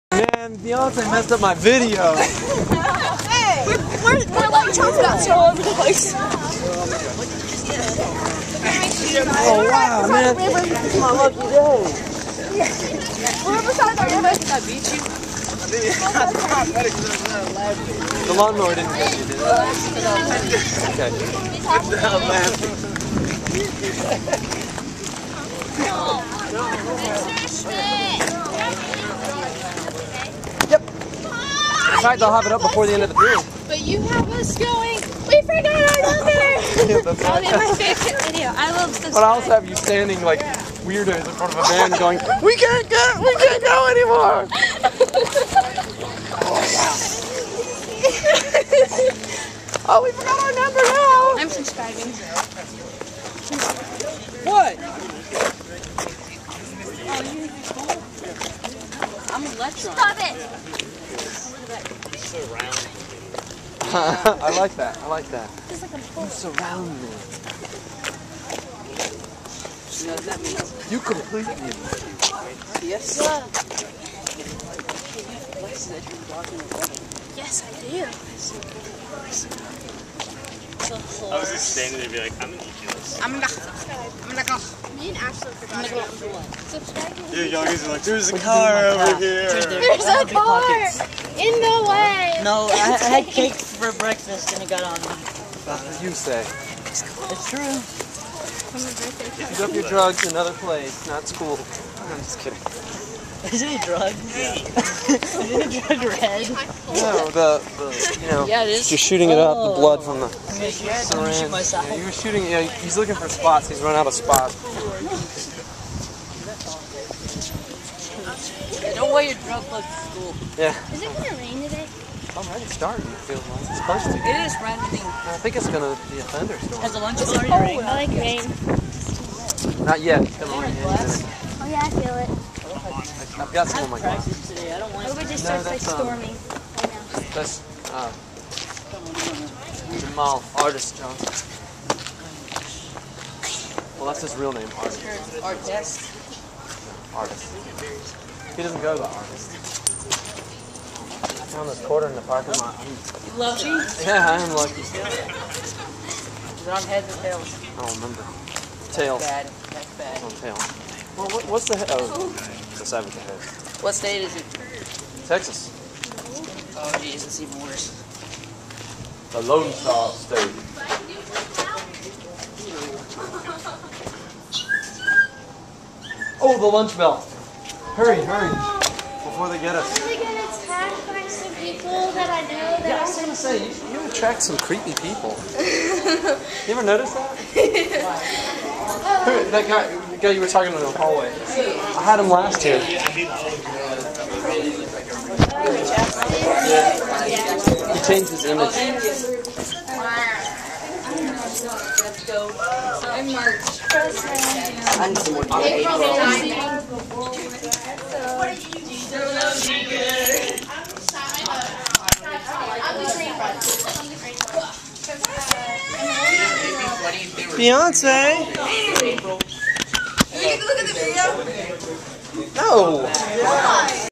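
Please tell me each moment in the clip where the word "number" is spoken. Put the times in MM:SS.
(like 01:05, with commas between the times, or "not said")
00:36, 00:50.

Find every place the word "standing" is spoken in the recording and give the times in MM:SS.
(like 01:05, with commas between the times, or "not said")
00:39, 01:21.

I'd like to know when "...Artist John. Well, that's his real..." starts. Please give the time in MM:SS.
02:20.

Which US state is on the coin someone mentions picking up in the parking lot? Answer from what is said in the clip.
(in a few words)
Texas.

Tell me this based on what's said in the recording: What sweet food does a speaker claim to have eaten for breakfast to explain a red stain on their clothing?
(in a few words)
cake.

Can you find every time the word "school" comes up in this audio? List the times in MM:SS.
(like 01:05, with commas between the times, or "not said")
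01:41, 01:59.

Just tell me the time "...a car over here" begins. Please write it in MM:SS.
01:28.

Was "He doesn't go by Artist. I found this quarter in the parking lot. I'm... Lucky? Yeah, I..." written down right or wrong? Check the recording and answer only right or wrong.
right.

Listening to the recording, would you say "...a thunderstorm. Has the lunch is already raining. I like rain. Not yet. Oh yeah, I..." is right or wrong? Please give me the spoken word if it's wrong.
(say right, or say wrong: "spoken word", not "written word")
right.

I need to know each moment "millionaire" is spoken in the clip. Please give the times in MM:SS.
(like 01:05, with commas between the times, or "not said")
not said.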